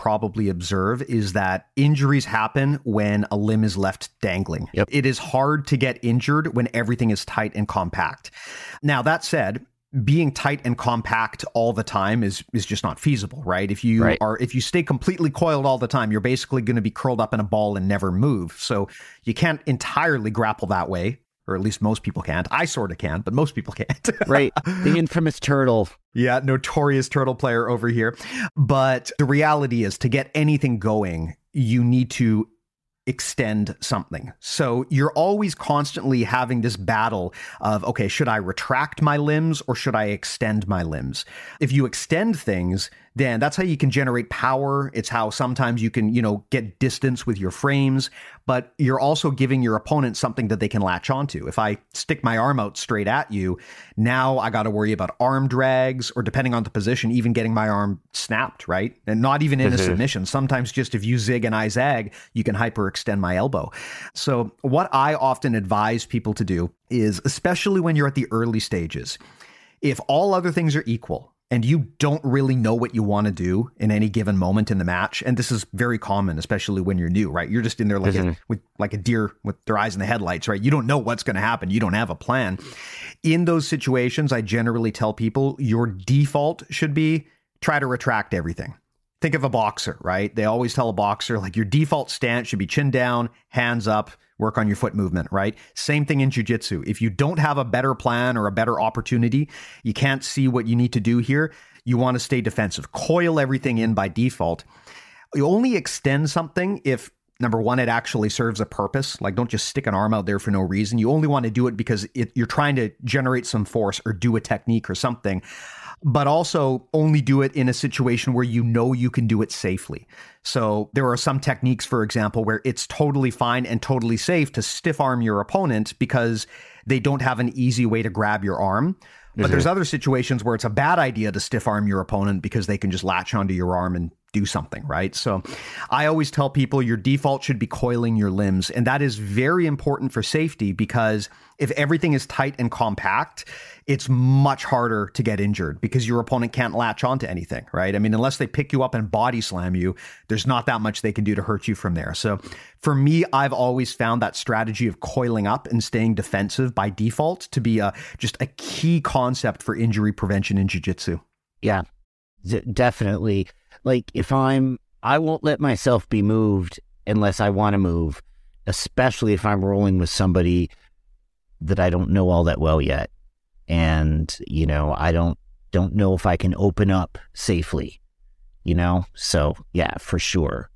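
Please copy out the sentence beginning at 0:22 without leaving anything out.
I sort of can, but most people can't.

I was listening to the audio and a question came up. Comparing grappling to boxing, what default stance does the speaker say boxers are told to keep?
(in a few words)
Chin down, hands up.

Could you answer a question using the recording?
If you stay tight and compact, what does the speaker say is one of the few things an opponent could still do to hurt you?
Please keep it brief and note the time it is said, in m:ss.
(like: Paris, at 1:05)
Body slam you, at 2:29.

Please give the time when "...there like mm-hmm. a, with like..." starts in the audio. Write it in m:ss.
1:17.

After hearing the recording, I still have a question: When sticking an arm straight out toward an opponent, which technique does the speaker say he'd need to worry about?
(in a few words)
Arm drags.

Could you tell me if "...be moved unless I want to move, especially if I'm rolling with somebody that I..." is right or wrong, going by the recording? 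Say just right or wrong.
right.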